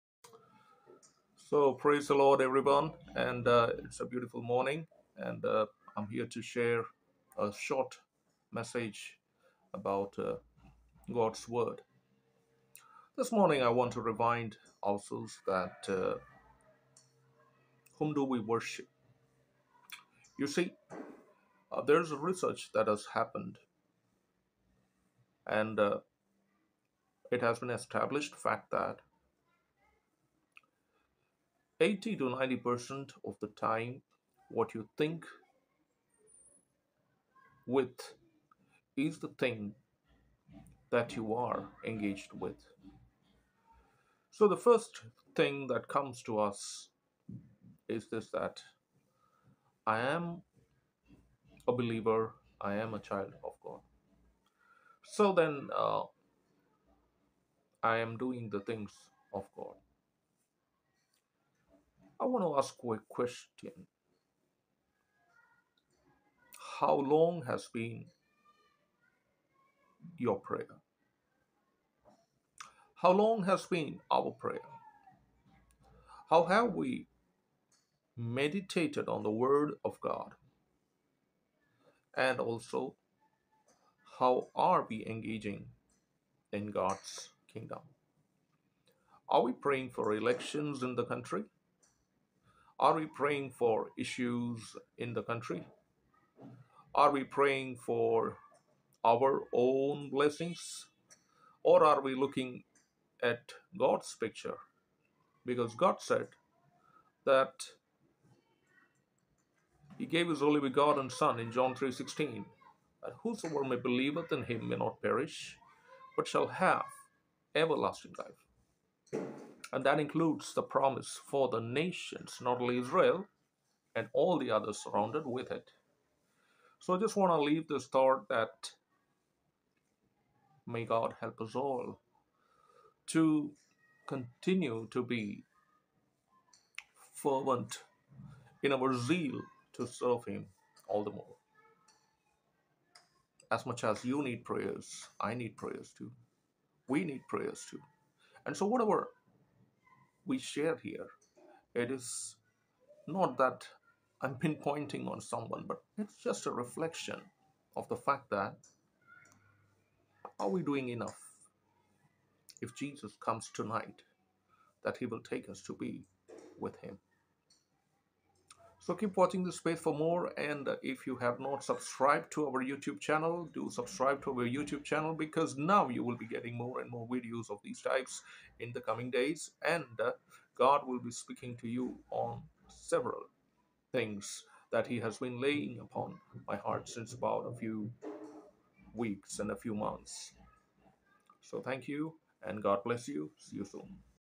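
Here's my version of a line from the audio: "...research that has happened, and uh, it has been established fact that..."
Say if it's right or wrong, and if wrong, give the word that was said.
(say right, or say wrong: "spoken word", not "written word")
right.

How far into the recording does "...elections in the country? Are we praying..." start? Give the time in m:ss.
1:30.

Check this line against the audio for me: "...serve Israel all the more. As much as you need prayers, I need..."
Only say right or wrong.
wrong.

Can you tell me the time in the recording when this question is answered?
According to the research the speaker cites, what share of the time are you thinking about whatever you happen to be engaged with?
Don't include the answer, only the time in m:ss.
0:31.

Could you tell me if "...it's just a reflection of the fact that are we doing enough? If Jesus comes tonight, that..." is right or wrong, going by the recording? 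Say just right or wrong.
right.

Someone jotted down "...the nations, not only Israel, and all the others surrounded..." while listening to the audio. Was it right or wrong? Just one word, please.
right.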